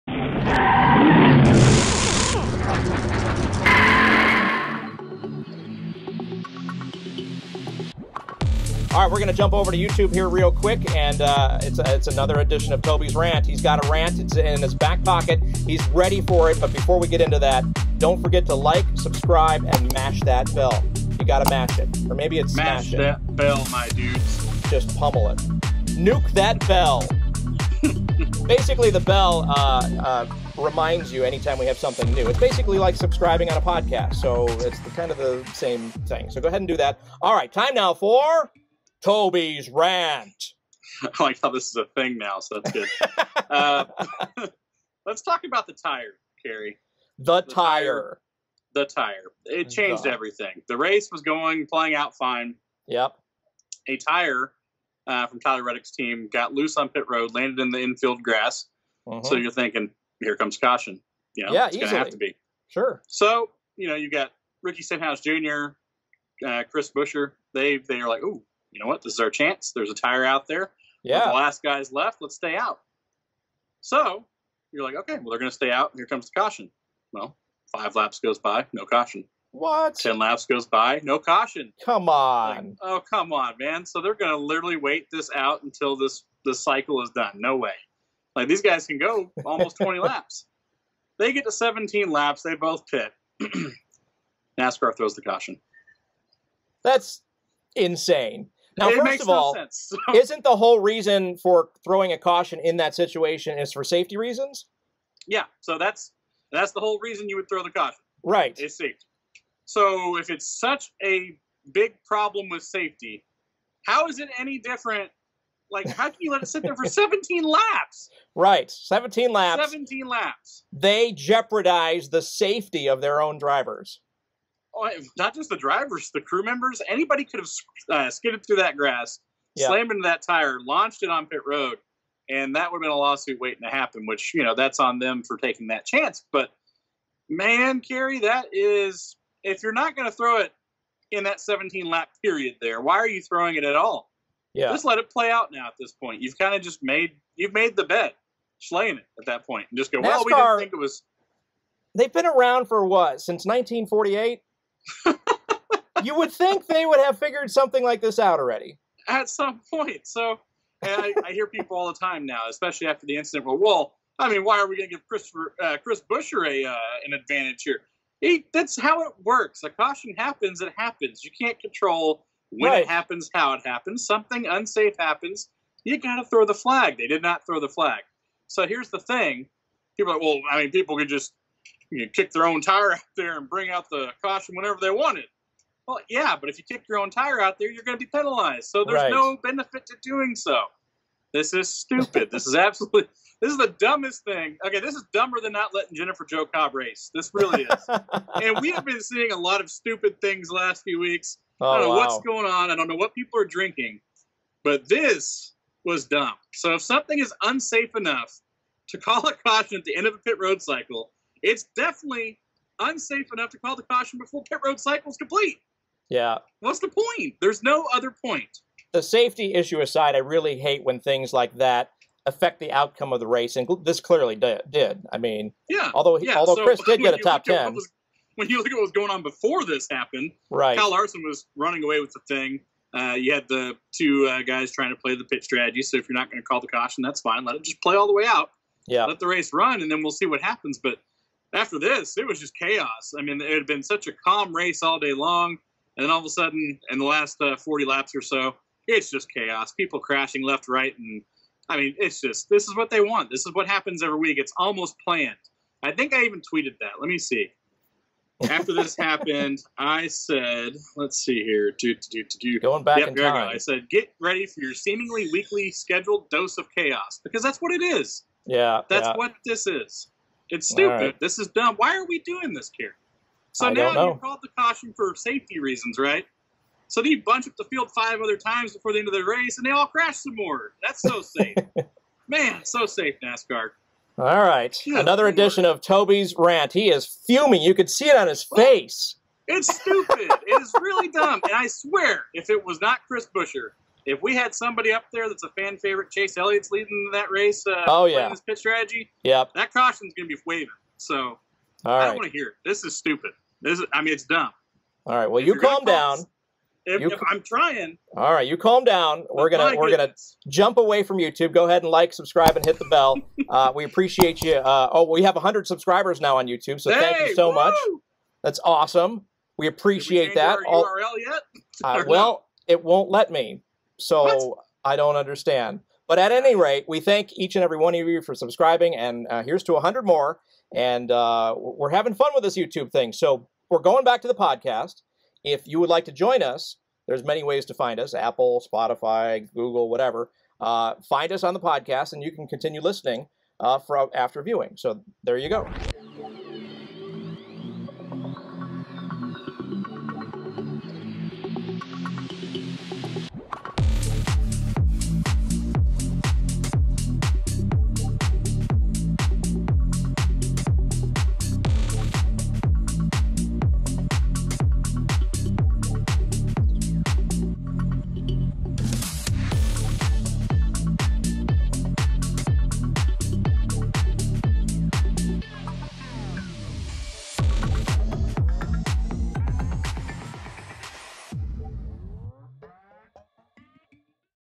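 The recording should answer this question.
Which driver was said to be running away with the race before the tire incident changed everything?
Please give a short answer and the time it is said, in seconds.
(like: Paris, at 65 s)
Kyle Larson, at 230 s.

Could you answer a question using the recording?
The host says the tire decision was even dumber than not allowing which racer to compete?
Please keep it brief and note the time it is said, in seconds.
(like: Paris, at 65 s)
Jennifer Jo Cobb, at 195 s.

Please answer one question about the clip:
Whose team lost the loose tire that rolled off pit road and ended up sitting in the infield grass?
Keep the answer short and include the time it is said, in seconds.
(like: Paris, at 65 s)
Tyler Reddick, at 55 s.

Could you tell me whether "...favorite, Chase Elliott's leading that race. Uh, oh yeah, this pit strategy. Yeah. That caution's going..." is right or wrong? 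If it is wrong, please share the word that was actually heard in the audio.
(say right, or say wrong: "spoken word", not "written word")
right.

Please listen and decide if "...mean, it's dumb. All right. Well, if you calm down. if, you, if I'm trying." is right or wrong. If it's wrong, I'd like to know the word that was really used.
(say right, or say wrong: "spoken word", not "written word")
right.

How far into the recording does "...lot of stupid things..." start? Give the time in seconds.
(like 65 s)
199 s.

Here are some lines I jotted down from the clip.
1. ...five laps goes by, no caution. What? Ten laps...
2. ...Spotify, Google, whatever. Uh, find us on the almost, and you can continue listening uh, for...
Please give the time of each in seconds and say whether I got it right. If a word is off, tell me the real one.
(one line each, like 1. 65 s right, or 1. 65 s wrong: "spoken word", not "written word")
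1. 77 s right
2. 338 s wrong: "podcast", not "almost".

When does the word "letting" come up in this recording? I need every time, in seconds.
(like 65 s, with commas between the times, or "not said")
195 s.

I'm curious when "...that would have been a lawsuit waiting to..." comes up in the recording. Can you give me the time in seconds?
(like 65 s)
132 s.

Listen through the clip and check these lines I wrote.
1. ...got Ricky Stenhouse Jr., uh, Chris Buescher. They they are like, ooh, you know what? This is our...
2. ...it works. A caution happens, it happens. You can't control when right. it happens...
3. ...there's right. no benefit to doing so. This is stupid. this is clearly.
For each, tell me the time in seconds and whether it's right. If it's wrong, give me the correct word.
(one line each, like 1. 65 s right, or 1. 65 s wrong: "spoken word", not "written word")
1. 64 s right
2. 169 s right
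3. 188 s wrong: "absolutely", not "clearly".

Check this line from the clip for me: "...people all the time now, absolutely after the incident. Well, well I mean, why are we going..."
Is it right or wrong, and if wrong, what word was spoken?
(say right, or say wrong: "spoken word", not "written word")
wrong: "especially", not "absolutely".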